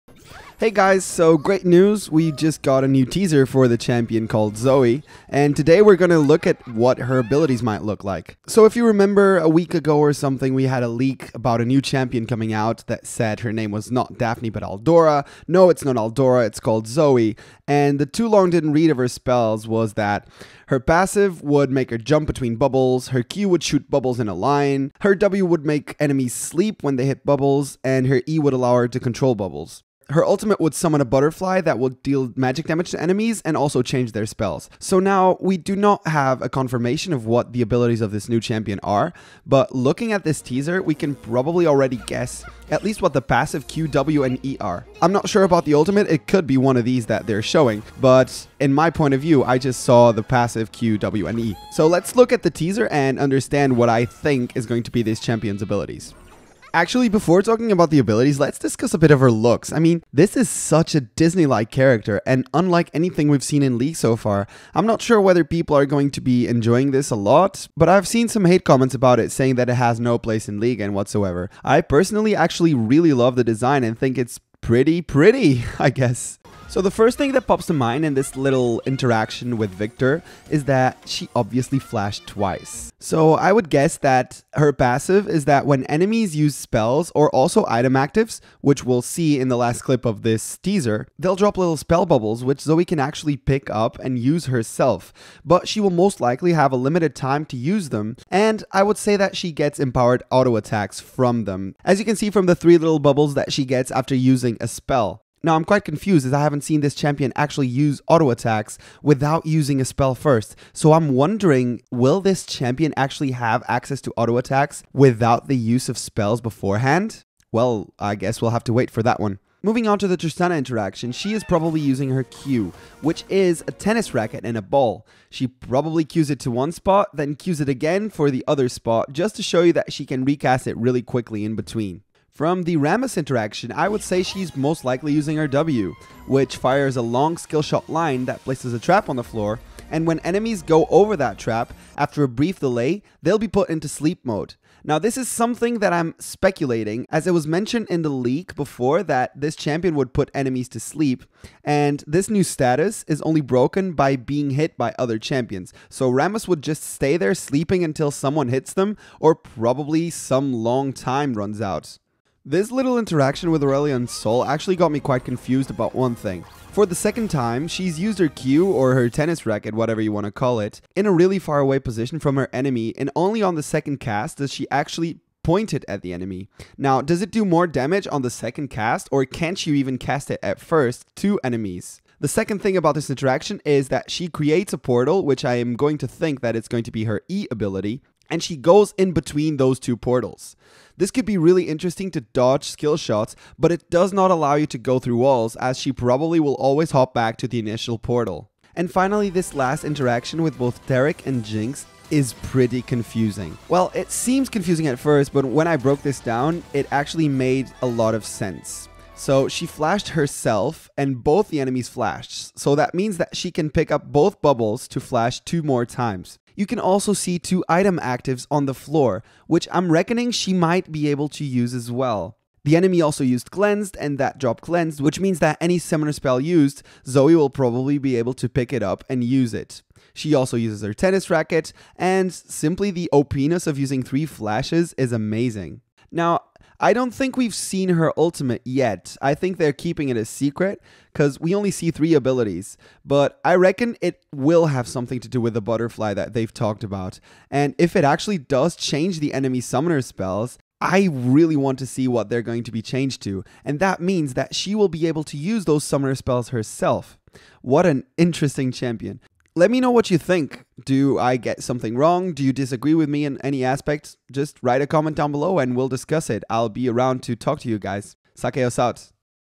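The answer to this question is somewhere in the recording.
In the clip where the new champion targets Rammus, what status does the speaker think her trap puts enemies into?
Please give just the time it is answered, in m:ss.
2:23.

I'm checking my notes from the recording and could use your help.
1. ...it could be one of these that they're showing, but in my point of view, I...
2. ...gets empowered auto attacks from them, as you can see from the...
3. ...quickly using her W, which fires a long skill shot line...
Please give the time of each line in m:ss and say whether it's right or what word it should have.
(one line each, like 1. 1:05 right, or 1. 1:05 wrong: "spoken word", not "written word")
1. 0:46 right
2. 1:39 right
3. 2:14 wrong: "likely", not "quickly".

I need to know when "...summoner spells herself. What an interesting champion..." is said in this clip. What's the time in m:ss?
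4:15.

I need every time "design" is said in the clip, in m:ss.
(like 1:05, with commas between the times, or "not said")
1:13.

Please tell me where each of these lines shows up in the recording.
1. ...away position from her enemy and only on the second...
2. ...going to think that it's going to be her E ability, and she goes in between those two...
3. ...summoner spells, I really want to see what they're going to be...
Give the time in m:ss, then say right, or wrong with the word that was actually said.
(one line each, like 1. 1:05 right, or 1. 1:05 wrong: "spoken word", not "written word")
1. 2:51 right
2. 3:05 right
3. 4:09 right.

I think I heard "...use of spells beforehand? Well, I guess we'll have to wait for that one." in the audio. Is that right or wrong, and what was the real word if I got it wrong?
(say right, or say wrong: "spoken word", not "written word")
right.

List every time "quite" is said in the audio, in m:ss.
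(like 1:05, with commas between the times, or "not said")
1:45, 2:44.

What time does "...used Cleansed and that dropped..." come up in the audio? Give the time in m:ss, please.
3:43.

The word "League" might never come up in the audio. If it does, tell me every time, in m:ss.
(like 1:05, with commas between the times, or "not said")
1:03, 1:10.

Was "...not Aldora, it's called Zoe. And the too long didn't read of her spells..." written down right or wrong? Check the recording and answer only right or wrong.
right.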